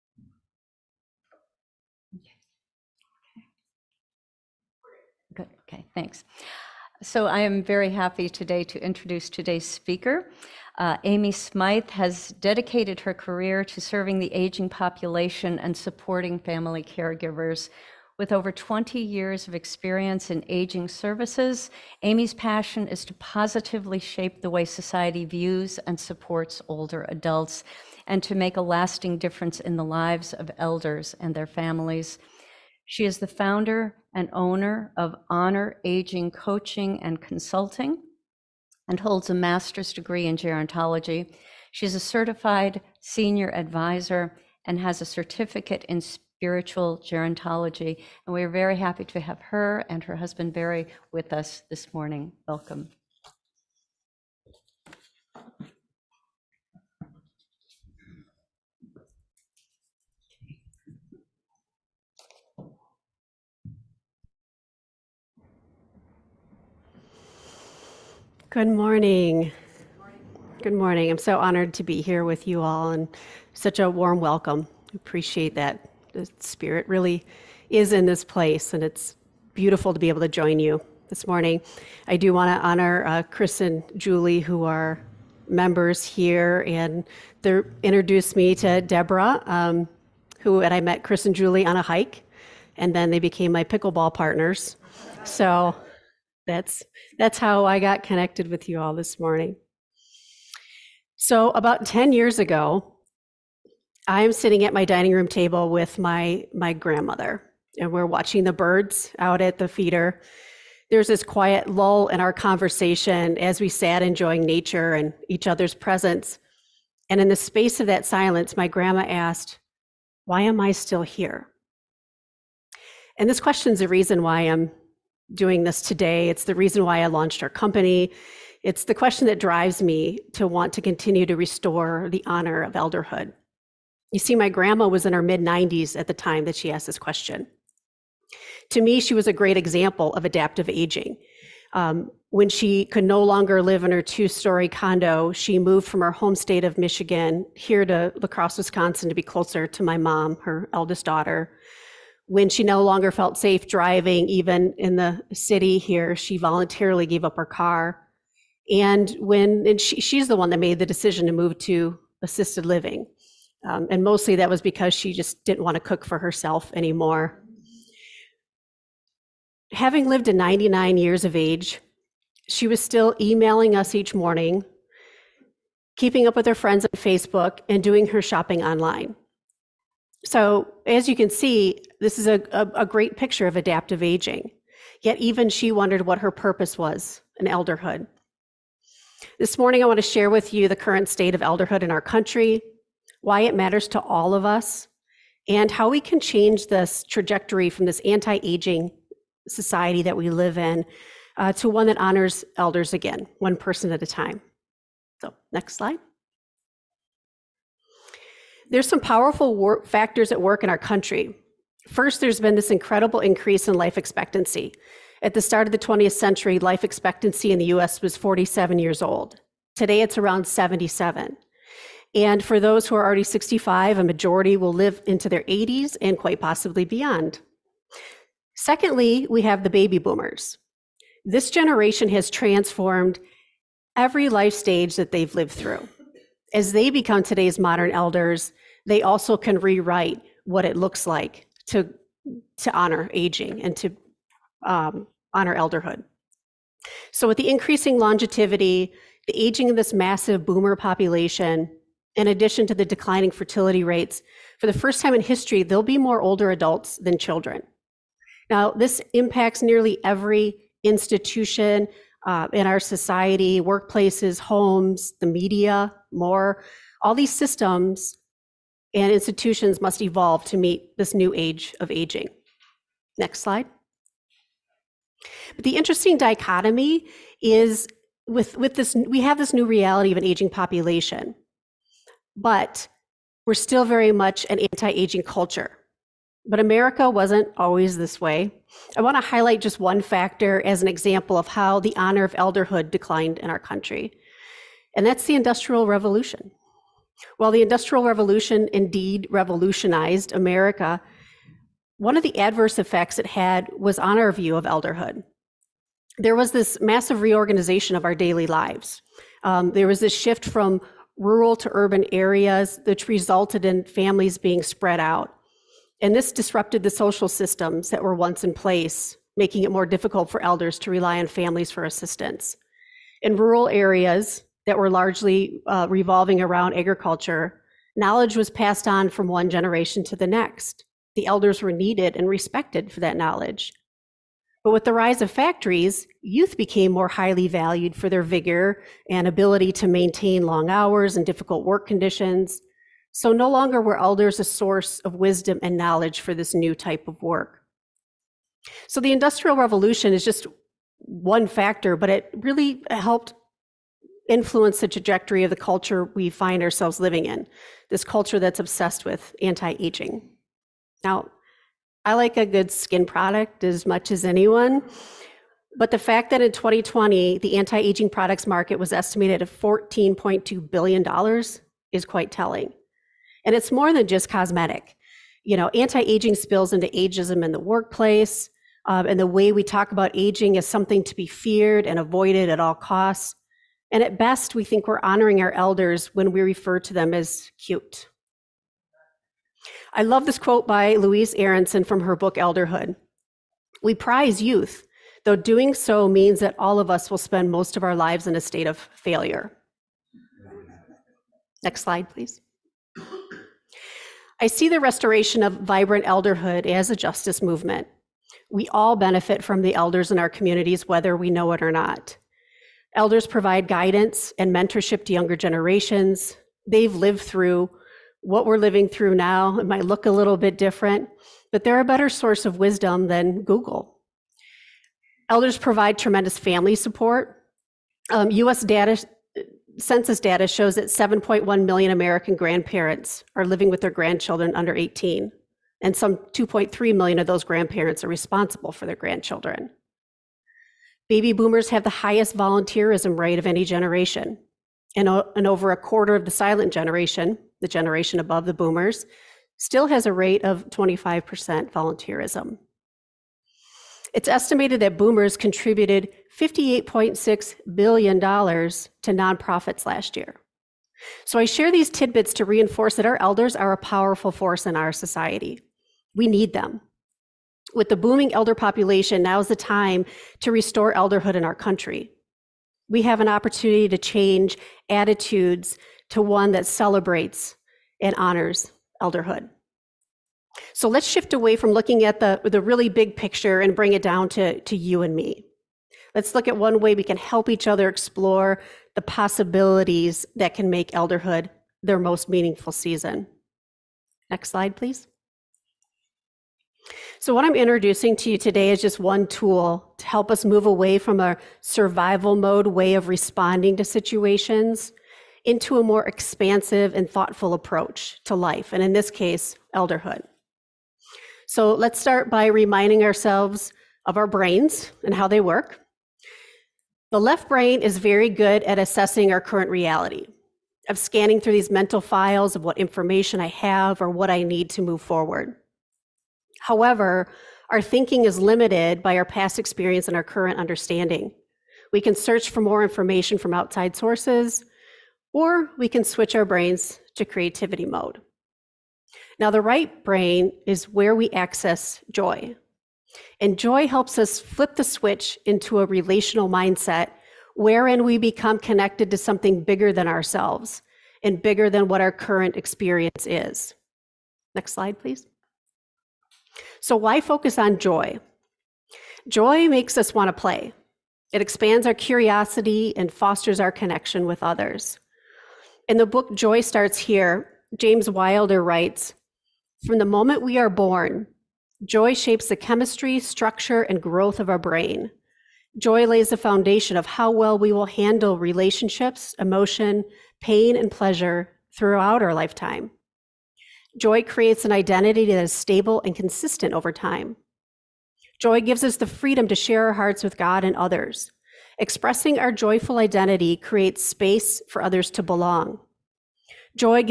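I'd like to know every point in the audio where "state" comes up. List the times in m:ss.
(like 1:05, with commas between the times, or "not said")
2:26, 3:11, 6:38.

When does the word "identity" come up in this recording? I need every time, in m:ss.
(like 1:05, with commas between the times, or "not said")
9:44, 9:52.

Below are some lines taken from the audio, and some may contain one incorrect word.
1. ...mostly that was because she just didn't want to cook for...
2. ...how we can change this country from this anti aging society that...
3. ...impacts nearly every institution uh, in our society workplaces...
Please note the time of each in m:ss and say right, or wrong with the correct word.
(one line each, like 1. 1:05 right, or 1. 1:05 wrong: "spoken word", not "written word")
1. 2:44 right
2. 3:15 wrong: "trajectory", not "country"
3. 4:19 right.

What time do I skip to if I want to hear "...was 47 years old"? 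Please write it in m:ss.
3:38.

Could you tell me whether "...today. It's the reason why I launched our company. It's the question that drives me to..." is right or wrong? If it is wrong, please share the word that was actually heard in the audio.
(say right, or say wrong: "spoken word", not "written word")
right.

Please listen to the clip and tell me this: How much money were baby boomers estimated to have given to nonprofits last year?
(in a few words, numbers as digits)
$58.6 billion.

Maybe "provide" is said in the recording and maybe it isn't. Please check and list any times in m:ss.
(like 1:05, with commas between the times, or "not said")
6:53, 7:05.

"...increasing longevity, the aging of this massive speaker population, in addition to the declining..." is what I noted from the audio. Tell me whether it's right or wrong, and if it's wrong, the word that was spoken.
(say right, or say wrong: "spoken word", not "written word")
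wrong: "boomer", not "speaker".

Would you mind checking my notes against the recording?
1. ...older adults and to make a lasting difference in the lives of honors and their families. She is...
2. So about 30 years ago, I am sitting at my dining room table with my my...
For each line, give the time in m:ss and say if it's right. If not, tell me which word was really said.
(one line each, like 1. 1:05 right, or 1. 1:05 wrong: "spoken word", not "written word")
1. 0:26 wrong: "elders", not "honors"
2. 1:41 wrong: "10", not "30".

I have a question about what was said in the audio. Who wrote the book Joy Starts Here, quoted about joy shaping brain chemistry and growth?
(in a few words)
James Wilder.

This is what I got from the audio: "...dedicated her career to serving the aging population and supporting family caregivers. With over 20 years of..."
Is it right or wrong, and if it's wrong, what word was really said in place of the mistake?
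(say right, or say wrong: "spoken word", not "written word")
right.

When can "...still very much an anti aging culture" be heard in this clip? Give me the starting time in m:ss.
4:43.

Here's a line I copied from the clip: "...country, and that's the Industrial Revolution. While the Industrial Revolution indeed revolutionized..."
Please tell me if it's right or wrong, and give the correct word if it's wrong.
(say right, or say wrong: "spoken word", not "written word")
right.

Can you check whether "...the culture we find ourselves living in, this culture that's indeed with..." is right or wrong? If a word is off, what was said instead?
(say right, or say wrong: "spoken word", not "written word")
wrong: "obsessed", not "indeed".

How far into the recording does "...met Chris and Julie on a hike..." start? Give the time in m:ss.
1:30.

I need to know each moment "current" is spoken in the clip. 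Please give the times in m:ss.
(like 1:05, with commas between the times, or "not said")
3:10, 8:39, 8:50, 9:12.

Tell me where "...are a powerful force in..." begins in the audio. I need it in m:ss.
7:43.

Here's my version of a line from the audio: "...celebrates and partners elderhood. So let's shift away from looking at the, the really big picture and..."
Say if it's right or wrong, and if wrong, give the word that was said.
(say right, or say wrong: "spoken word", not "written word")
wrong: "honors", not "partners".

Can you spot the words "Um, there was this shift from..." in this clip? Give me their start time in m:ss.
5:09.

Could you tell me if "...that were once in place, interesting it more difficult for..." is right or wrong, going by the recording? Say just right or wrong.
wrong.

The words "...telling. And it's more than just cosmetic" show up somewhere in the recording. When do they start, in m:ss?
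6:12.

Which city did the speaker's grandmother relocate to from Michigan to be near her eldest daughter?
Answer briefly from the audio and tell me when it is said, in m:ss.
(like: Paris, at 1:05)
La Crosse, Wisconsin, at 2:28.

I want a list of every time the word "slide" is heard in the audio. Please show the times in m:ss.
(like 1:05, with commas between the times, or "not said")
3:25, 4:33, 6:41, 8:14, 9:14.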